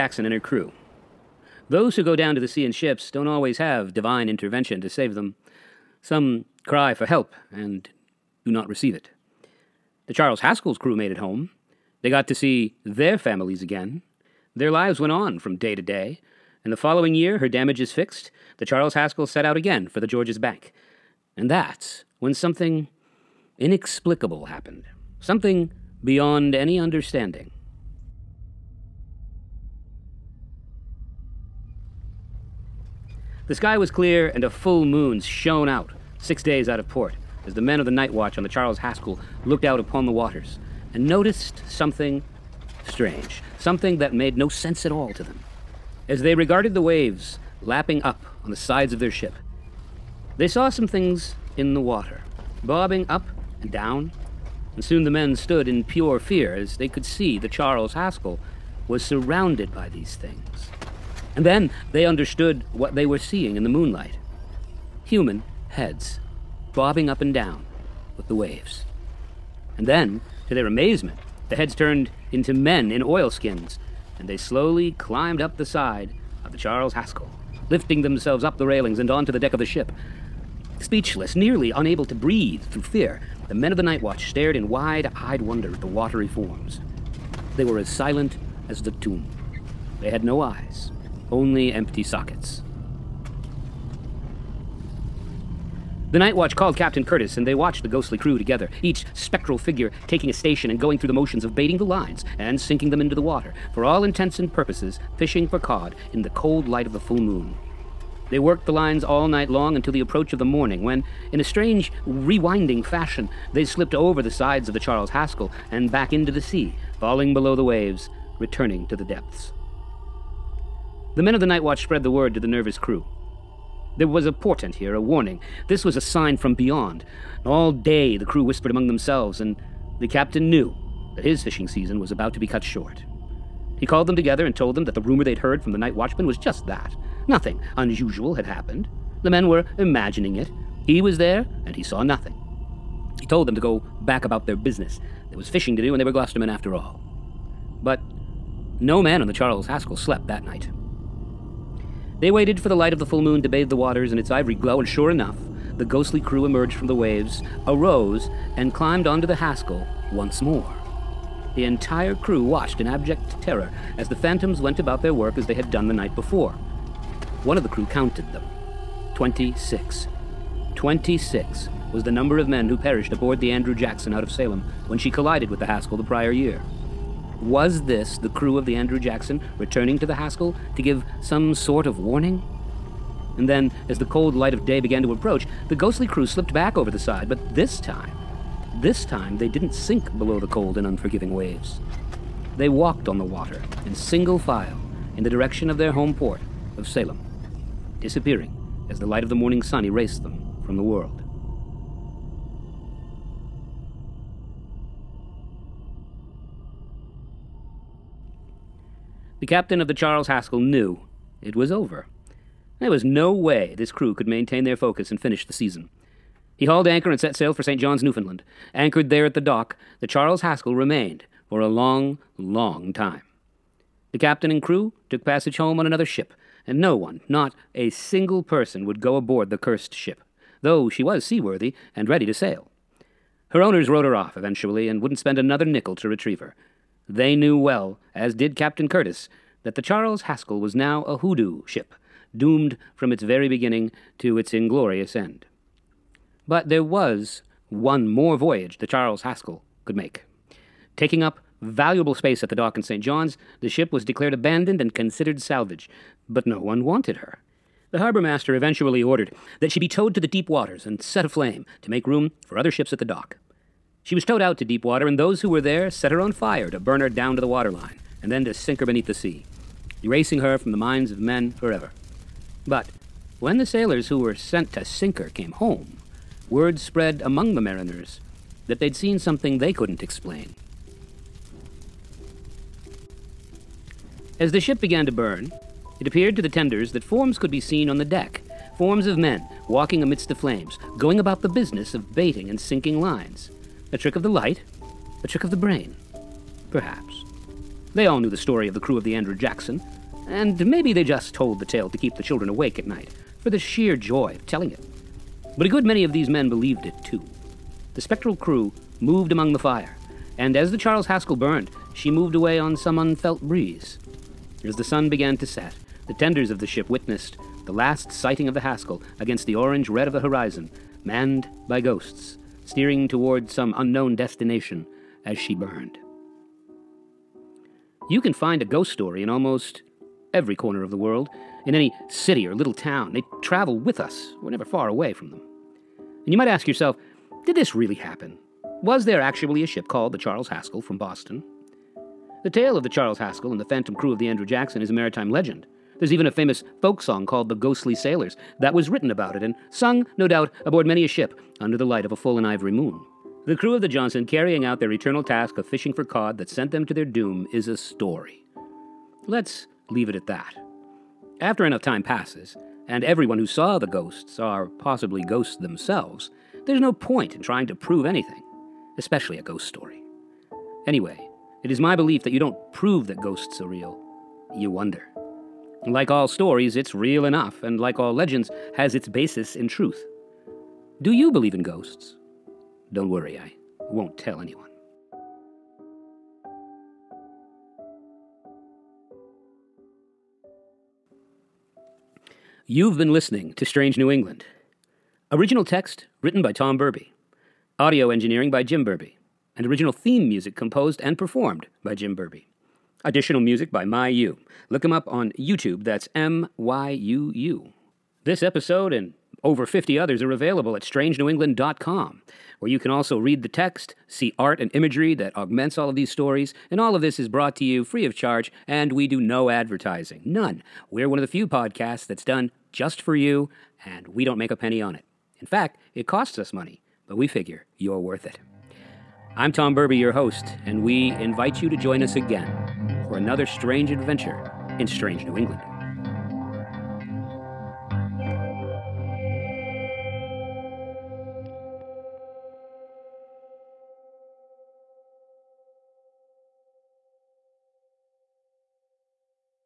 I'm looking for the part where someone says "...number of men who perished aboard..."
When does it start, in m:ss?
2:52.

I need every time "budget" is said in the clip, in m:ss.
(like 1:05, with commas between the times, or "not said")
not said.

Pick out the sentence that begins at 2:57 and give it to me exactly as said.
Was this the crew of the Andrew Jackson returning to the Haskell to give some sort of warning?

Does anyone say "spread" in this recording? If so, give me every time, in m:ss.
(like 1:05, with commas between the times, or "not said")
2:01, 4:36.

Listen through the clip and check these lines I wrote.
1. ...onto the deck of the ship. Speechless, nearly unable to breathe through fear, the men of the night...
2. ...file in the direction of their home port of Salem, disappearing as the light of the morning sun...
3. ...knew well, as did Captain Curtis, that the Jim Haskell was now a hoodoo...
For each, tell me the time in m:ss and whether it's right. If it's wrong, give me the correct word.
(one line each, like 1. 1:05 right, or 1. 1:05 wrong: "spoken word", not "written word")
1. 1:19 right
2. 3:14 right
3. 3:57 wrong: "Charles", not "Jim".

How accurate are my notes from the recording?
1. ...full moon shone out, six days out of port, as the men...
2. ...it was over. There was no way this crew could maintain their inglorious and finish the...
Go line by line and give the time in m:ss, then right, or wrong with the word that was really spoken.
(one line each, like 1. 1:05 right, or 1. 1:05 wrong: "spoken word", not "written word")
1. 0:34 right
2. 3:31 wrong: "focus", not "inglorious".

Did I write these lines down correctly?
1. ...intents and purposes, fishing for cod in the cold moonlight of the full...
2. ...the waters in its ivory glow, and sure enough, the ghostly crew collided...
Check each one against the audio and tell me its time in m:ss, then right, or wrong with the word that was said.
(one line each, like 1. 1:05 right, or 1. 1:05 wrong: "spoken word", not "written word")
1. 1:44 wrong: "light", not "moonlight"
2. 2:33 wrong: "emerged", not "collided".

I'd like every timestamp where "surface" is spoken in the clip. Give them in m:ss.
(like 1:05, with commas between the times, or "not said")
not said.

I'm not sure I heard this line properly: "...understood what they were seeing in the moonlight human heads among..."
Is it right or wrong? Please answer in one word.
wrong.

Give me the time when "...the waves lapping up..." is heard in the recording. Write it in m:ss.
0:46.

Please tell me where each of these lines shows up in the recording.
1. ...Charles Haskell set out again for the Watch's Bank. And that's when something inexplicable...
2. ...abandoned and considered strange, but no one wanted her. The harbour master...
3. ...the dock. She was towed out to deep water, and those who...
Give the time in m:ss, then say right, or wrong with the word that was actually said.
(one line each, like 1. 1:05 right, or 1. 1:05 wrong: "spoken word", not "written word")
1. 0:18 wrong: "George", not "Watch"
2. 4:14 wrong: "salvage", not "strange"
3. 4:22 right.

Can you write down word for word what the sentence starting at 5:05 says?
But a good many of these men believed it too.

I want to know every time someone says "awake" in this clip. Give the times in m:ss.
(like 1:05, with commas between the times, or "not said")
5:02.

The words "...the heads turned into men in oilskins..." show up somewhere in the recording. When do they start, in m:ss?
1:11.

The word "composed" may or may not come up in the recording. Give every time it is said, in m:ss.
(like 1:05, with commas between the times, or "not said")
6:40.